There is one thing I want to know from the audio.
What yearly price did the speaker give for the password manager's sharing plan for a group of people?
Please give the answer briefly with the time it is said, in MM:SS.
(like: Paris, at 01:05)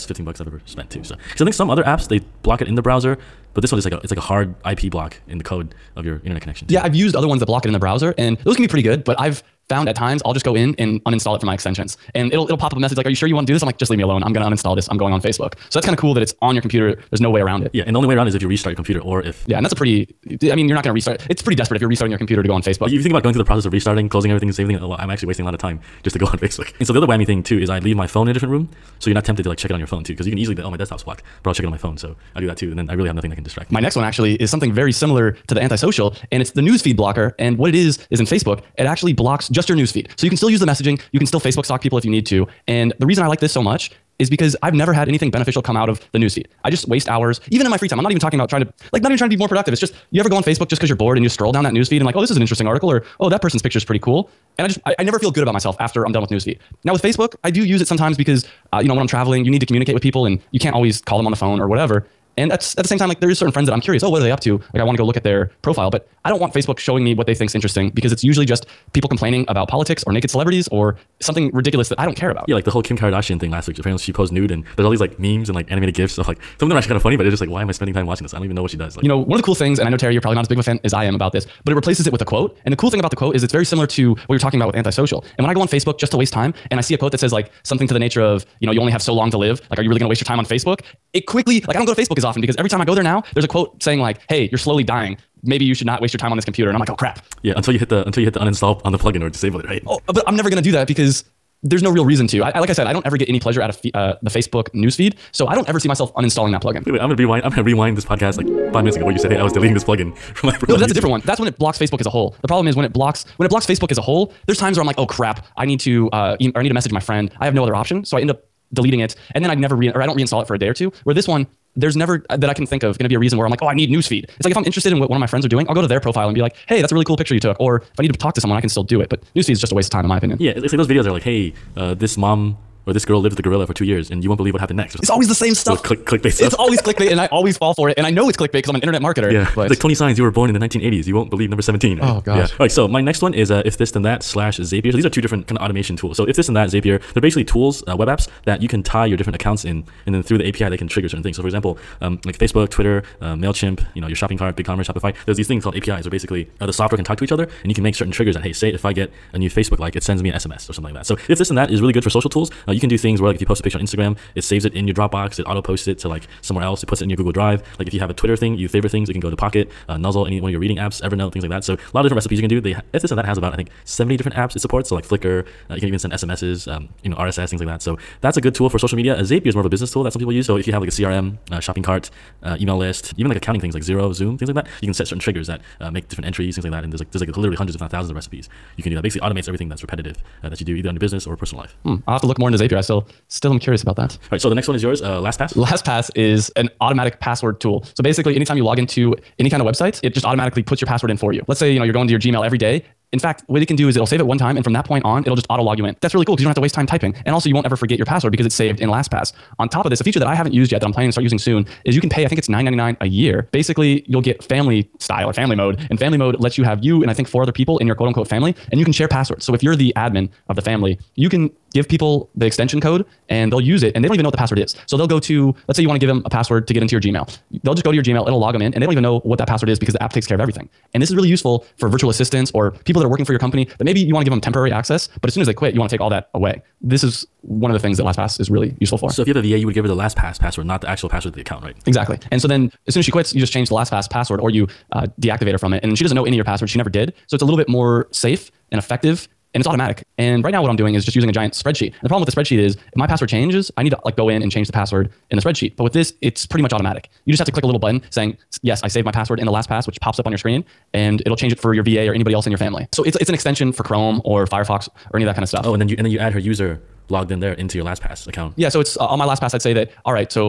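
$9.99, at 03:32.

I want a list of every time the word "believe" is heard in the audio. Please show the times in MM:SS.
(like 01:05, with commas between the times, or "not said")
02:14, 02:21.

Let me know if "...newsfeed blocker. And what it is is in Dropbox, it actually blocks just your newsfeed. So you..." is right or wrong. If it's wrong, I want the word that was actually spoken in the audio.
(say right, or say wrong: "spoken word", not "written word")
wrong: "Facebook", not "Dropbox".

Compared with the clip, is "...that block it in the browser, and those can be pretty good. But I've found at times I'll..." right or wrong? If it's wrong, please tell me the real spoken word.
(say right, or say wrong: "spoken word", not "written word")
right.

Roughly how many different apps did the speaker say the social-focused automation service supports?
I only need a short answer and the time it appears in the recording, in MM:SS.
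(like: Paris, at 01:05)
70, at 02:53.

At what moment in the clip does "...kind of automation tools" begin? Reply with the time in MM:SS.
02:25.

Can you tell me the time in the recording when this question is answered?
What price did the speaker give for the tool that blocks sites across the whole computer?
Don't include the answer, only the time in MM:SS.
00:00.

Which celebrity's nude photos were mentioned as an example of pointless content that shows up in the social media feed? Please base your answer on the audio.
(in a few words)
Kim Kardashian.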